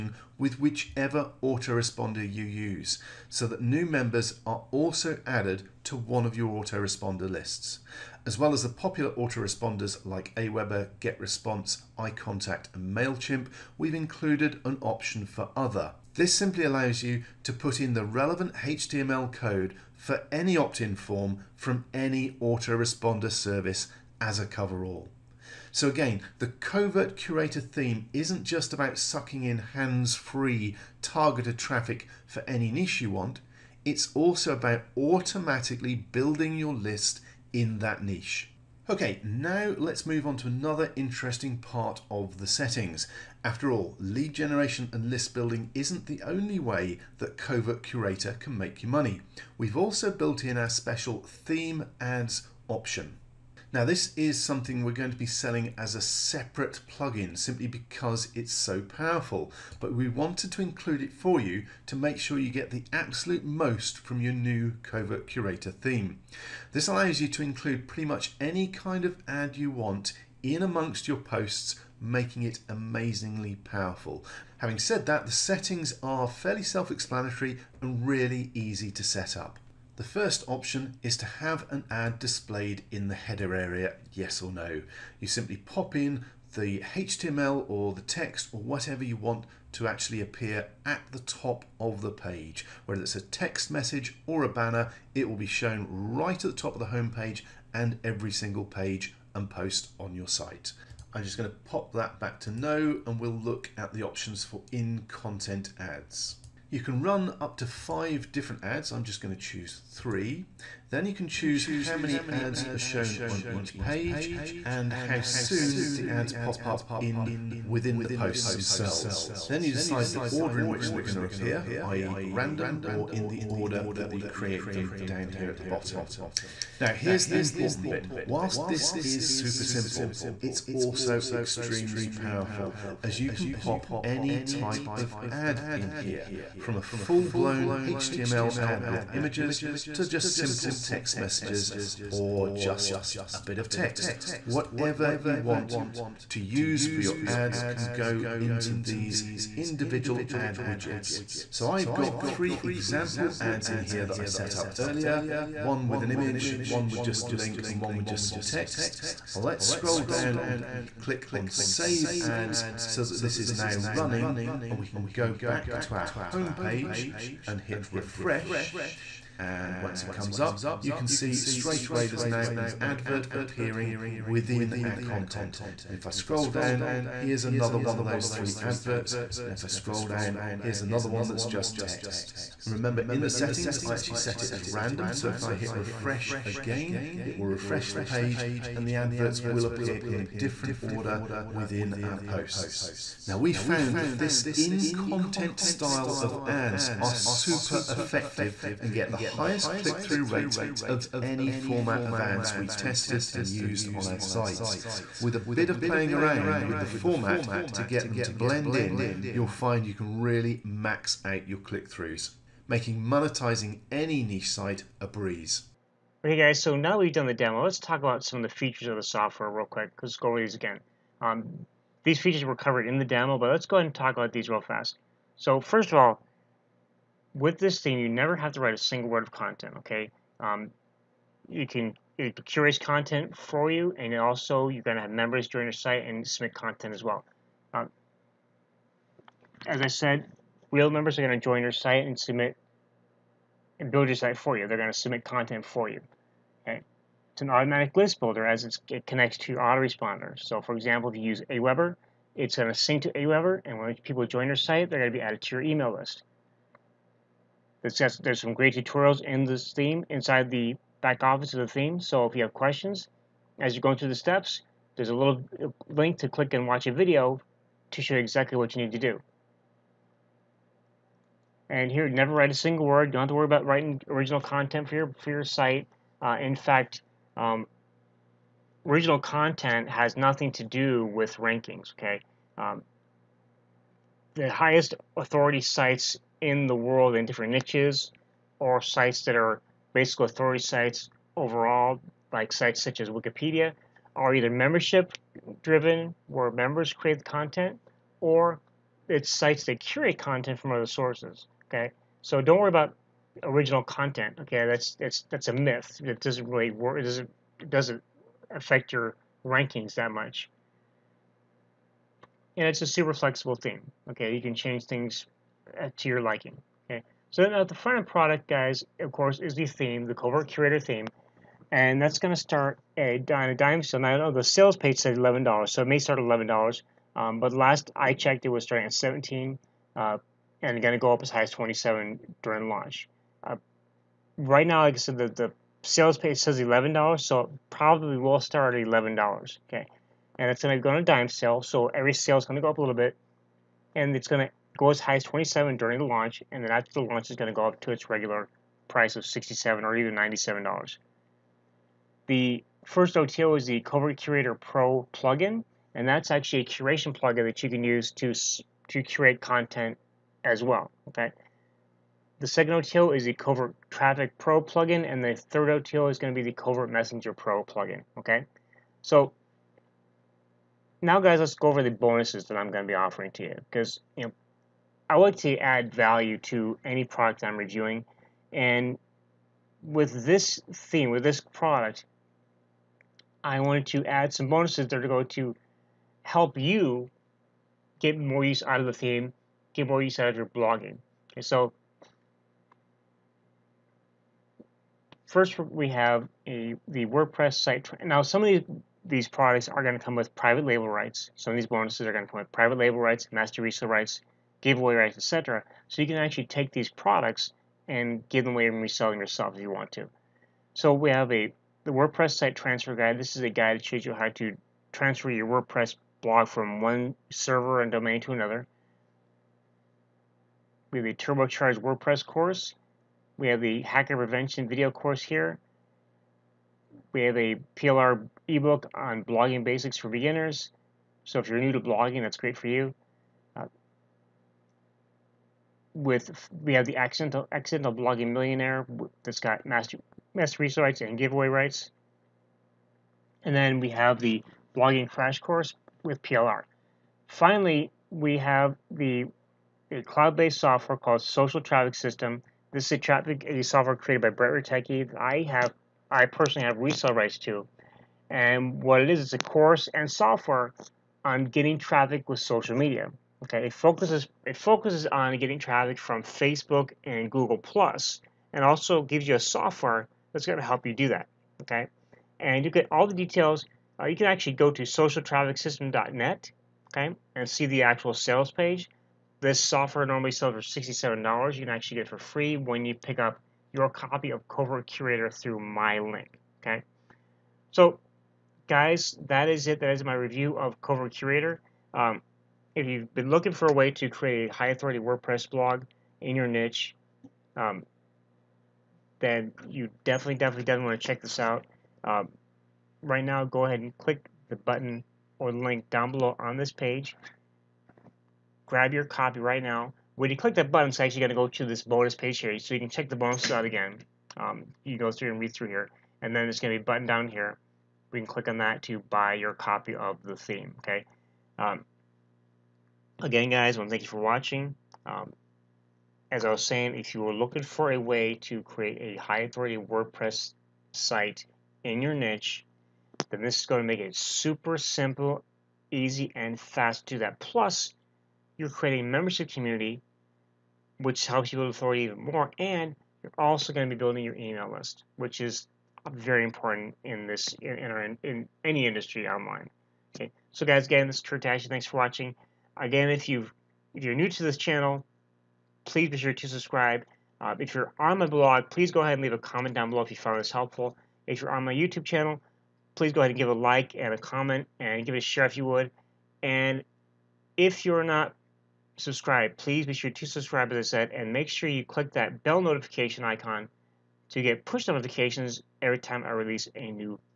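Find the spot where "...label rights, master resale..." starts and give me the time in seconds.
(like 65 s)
402 s.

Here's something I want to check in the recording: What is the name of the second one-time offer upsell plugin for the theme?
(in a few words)
Covert Traffic Pro.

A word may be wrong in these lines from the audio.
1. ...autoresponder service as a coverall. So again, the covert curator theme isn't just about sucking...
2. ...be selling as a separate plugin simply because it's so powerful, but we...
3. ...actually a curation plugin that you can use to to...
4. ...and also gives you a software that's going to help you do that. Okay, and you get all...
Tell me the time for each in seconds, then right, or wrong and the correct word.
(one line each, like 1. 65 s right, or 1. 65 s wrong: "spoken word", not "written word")
1. 22 s right
2. 55 s right
3. 356 s right
4. 468 s right.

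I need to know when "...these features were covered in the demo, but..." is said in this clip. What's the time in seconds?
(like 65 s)
222 s.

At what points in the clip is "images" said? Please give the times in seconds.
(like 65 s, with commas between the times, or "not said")
139 s, 156 s.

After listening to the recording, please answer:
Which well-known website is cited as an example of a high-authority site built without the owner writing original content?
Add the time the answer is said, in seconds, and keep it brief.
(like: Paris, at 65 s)
Wikipedia, at 293 s.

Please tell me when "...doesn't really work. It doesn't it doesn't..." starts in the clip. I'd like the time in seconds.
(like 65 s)
306 s.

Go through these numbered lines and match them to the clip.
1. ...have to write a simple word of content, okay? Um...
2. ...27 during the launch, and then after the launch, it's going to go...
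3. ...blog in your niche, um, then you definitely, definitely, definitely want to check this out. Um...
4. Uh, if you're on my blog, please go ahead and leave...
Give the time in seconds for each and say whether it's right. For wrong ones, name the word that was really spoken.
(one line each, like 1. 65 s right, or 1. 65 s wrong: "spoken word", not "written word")
1. 228 s wrong: "single", not "simple"
2. 345 s right
3. 495 s right
4. 557 s right.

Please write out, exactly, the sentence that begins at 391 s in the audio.
Okay, so First, we have a, the WordPress site.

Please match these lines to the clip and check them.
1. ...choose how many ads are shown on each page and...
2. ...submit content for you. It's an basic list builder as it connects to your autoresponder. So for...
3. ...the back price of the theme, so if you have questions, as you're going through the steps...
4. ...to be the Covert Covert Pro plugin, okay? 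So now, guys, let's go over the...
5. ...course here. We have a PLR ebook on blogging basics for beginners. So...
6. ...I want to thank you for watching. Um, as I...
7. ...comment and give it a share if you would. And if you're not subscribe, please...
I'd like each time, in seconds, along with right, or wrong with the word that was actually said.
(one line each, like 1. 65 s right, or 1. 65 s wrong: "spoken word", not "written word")
1. 111 s right
2. 244 s wrong: "automatic", not "basic"
3. 260 s wrong: "office", not "price"
4. 366 s wrong: "Messenger", not "Covert"
5. 424 s right
6. 523 s right
7. 564 s right.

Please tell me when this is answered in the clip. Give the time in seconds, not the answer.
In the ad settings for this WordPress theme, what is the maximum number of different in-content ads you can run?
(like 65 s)
107 s.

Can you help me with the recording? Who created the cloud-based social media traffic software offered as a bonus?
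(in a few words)
Brett Rutecki.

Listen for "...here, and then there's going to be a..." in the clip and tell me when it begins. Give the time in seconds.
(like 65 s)
515 s.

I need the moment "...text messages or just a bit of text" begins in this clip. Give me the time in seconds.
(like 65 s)
140 s.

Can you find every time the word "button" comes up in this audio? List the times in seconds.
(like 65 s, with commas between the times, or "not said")
504 s, 510 s, 516 s.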